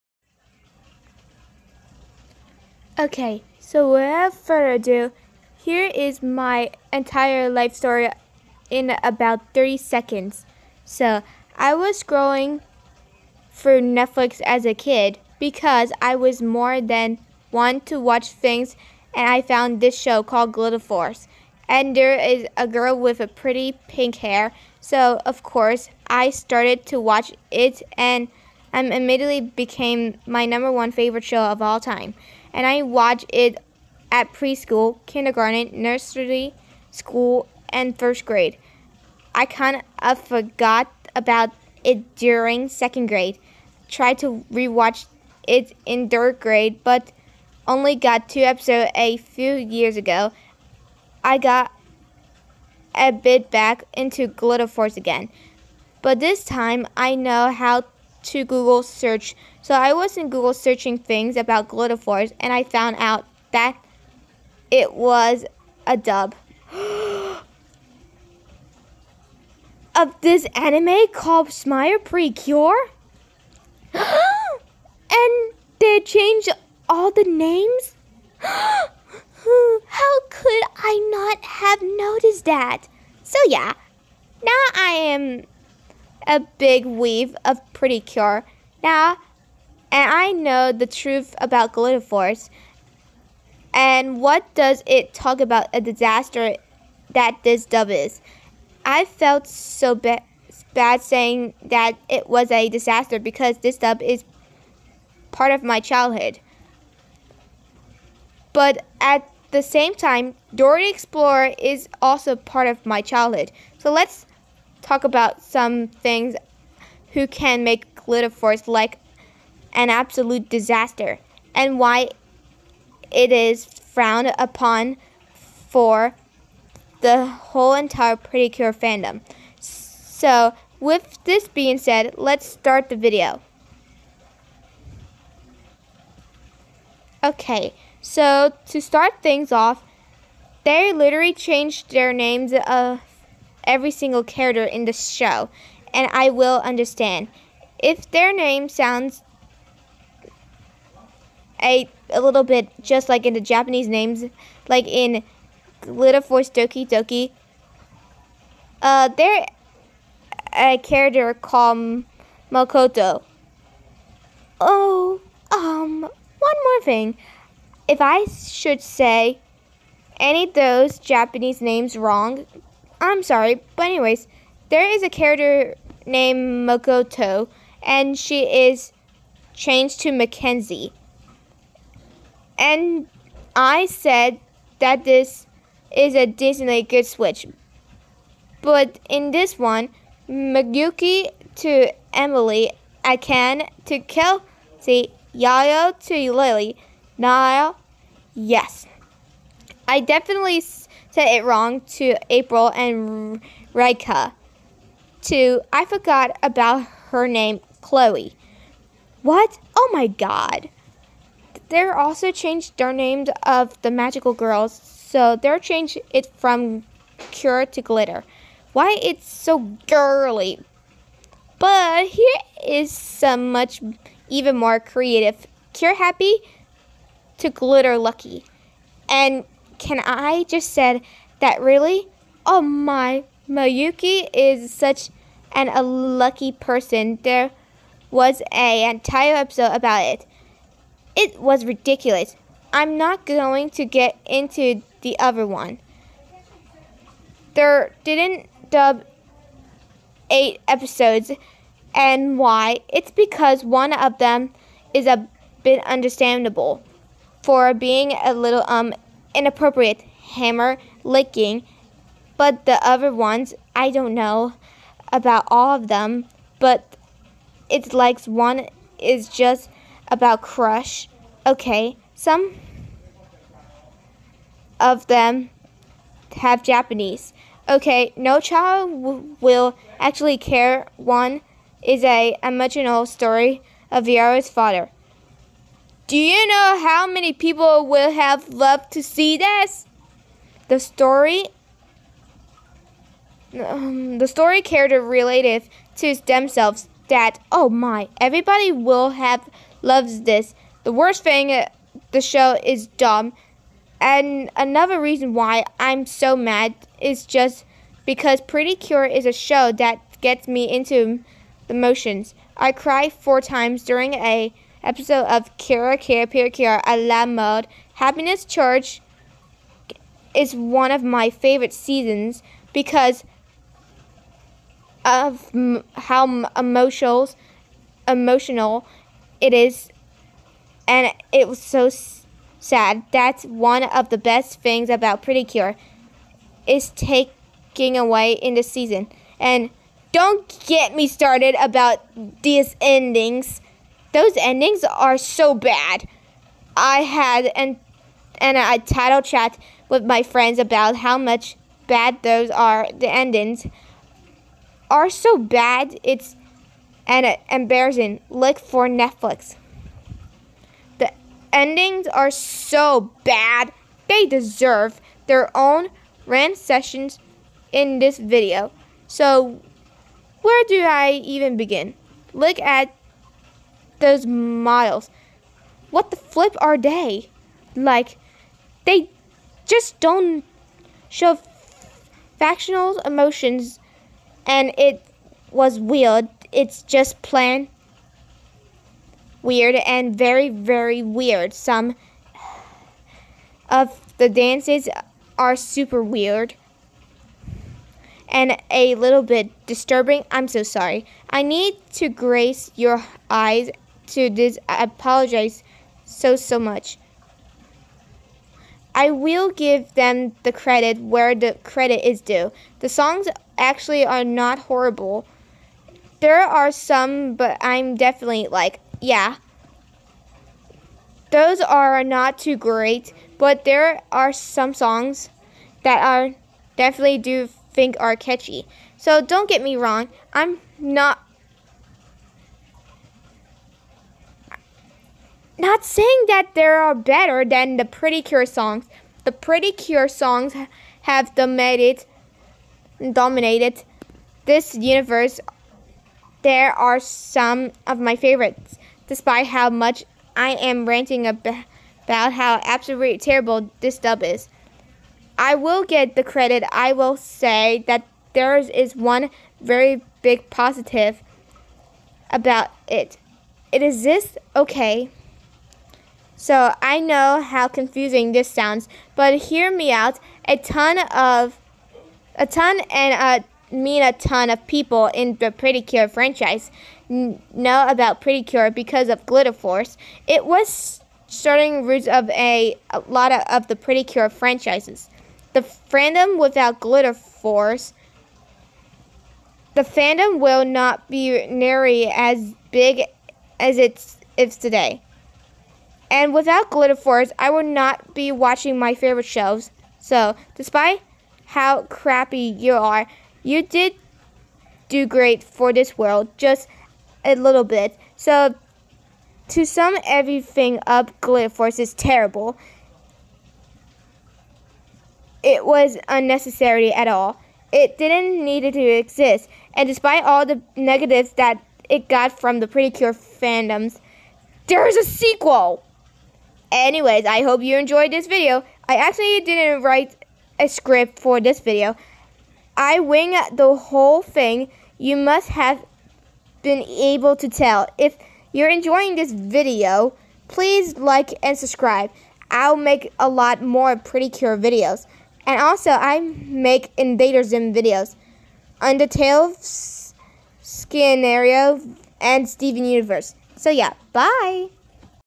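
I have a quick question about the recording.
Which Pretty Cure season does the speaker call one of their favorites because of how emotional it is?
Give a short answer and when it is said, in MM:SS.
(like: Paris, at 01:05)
Happiness Charge, at 05:17.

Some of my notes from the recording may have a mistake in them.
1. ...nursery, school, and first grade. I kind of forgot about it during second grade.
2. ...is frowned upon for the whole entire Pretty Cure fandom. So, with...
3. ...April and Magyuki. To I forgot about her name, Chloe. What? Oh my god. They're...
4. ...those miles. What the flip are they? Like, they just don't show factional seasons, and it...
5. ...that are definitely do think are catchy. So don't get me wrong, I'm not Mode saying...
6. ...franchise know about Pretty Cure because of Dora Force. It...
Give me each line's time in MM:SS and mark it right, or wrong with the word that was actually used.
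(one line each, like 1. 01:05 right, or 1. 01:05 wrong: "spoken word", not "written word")
1. 00:35 right
2. 02:03 right
3. 03:22 wrong: "Rika", not "Magyuki"
4. 06:14 wrong: "emotions", not "seasons"
5. 07:05 wrong: "Not", not "Mode"
6. 07:56 wrong: "Glitter", not "Dora".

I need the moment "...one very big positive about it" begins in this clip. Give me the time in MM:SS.
07:38.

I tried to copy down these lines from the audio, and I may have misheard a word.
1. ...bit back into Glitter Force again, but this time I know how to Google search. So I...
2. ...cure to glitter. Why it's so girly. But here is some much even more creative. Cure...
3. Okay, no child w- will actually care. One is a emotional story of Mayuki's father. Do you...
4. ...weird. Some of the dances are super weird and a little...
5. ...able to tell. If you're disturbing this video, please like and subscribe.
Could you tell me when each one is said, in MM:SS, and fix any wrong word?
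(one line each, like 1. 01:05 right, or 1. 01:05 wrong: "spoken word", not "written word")
1. 00:53 right
2. 03:37 right
3. 04:37 wrong: "Yara", not "Mayuki"
4. 06:31 right
5. 08:56 wrong: "enjoying", not "disturbing".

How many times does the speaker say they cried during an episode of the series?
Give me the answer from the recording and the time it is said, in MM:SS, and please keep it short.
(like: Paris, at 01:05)
4, at 05:13.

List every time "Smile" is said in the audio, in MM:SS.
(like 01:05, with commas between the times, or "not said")
01:11.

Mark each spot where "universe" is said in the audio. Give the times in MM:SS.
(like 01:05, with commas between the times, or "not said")
07:24, 09:12.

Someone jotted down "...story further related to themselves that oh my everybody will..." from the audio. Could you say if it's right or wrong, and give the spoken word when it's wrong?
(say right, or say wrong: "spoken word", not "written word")
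wrong: "character", not "further".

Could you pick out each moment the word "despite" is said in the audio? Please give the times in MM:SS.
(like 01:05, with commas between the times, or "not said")
07:29, 08:20, 08:39.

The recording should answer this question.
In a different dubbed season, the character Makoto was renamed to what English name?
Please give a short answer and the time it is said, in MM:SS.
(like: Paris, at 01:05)
Mackenzie, at 03:00.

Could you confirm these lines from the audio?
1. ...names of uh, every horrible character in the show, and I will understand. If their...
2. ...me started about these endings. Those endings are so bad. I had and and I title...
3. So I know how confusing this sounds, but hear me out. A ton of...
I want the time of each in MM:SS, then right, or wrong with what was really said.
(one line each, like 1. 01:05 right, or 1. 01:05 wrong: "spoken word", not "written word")
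1. 02:22 wrong: "single", not "horrible"
2. 05:40 right
3. 07:46 right.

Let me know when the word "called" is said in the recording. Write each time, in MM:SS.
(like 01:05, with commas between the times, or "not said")
00:20, 01:11, 02:41.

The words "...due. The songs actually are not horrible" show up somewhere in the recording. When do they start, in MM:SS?
06:52.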